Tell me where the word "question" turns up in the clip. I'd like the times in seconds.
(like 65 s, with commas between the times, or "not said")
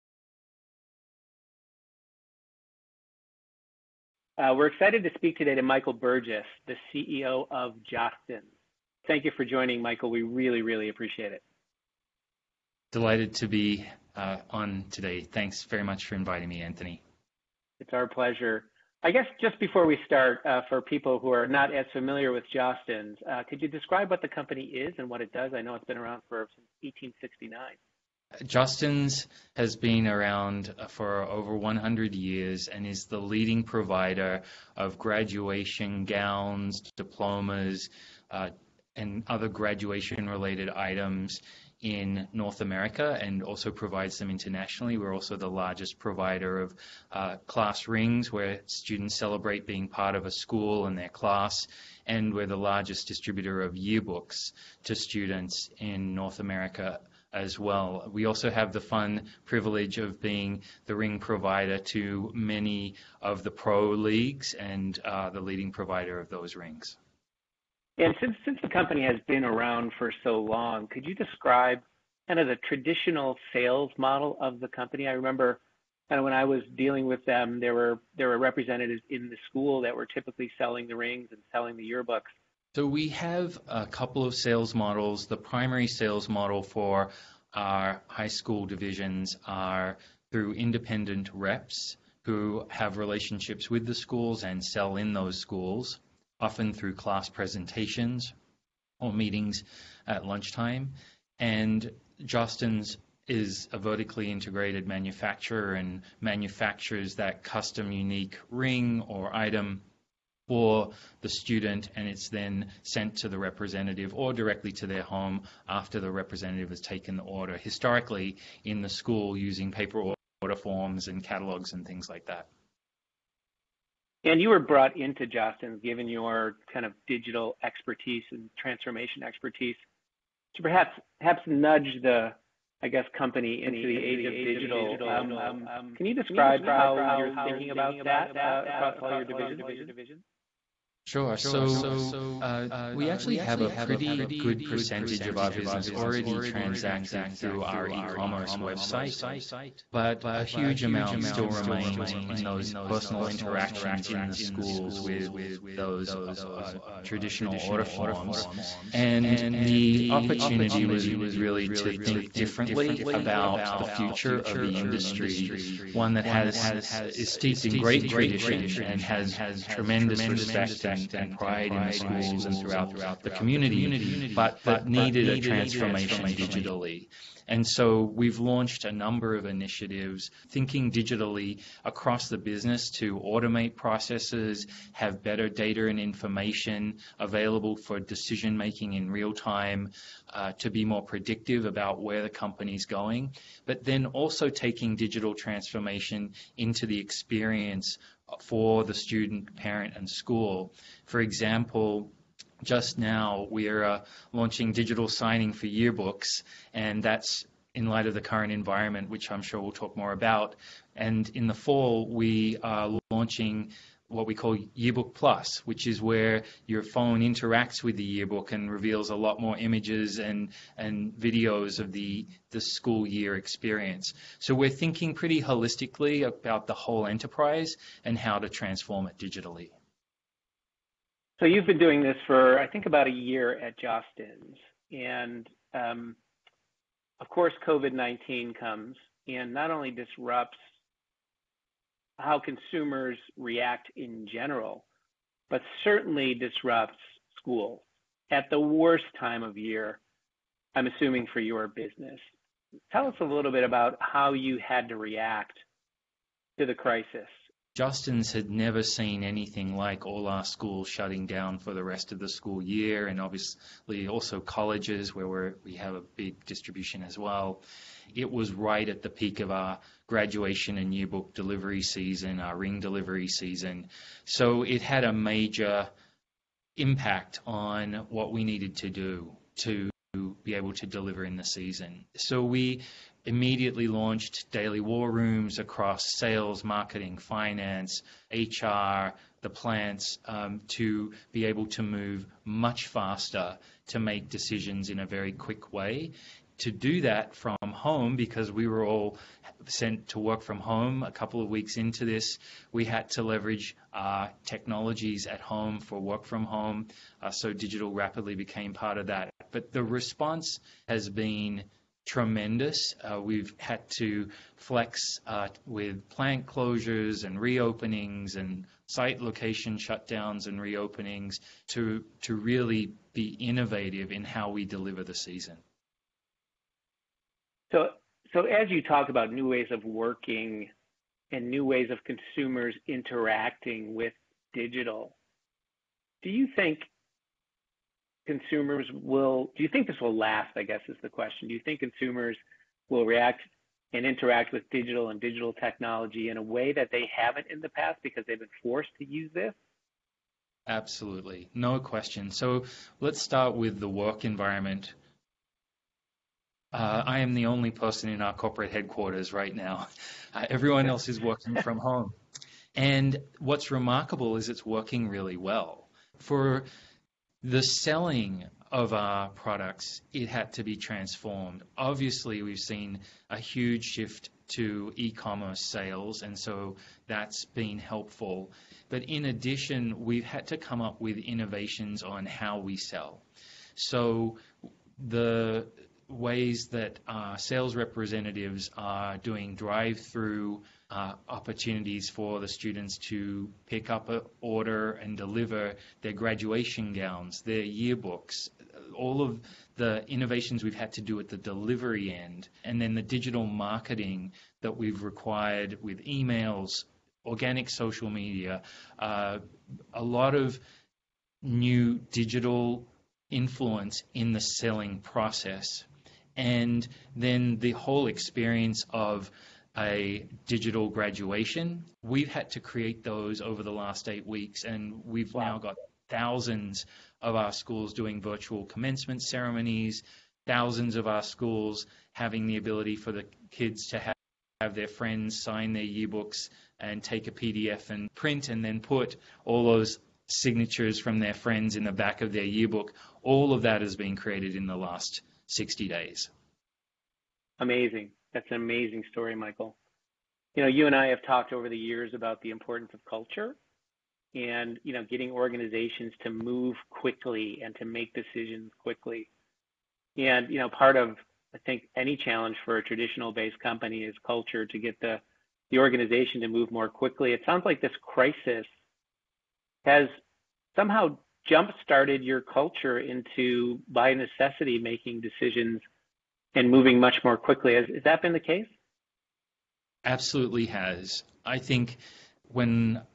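341 s, 351 s.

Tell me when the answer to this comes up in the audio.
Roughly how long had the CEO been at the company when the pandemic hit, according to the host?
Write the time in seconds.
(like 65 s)
232 s.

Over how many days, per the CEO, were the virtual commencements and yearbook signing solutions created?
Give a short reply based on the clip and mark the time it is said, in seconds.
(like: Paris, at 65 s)
60, at 445 s.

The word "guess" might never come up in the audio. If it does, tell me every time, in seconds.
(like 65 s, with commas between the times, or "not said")
19 s, 132 s, 340 s.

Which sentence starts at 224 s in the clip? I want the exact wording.
So we're thinking pretty holistically about the whole enterprise and how to transform it digitally.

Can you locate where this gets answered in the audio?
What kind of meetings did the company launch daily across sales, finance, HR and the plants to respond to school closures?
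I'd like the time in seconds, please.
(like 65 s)
284 s.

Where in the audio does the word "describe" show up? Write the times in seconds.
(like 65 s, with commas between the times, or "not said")
23 s, 71 s, 136 s.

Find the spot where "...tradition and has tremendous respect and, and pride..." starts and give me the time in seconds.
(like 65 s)
168 s.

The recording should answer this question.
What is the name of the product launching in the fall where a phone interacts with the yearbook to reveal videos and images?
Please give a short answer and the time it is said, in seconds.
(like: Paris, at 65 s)
Yearbook Plus, at 214 s.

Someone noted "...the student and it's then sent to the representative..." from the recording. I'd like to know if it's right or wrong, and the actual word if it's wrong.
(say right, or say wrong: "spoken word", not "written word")
right.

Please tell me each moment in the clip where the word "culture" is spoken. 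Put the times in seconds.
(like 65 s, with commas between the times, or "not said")
453 s, 464 s, 472 s.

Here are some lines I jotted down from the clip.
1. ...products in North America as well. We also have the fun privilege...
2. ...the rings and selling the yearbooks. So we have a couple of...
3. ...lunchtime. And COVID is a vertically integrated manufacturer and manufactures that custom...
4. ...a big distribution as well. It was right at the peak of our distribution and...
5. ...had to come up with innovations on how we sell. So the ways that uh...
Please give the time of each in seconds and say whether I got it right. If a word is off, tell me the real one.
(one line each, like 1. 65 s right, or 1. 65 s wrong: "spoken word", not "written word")
1. 54 s wrong: "students", not "products"
2. 80 s right
3. 100 s wrong: "Jostens", not "COVID"
4. 265 s wrong: "graduation", not "distribution"
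5. 380 s right.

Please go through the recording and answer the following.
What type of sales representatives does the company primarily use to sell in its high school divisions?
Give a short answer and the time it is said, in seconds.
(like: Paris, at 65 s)
Independent reps, at 90 s.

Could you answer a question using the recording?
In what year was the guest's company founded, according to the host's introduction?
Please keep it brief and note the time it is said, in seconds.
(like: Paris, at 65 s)
1869, at 26 s.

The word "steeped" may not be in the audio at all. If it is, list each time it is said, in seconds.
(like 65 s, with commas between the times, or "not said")
167 s.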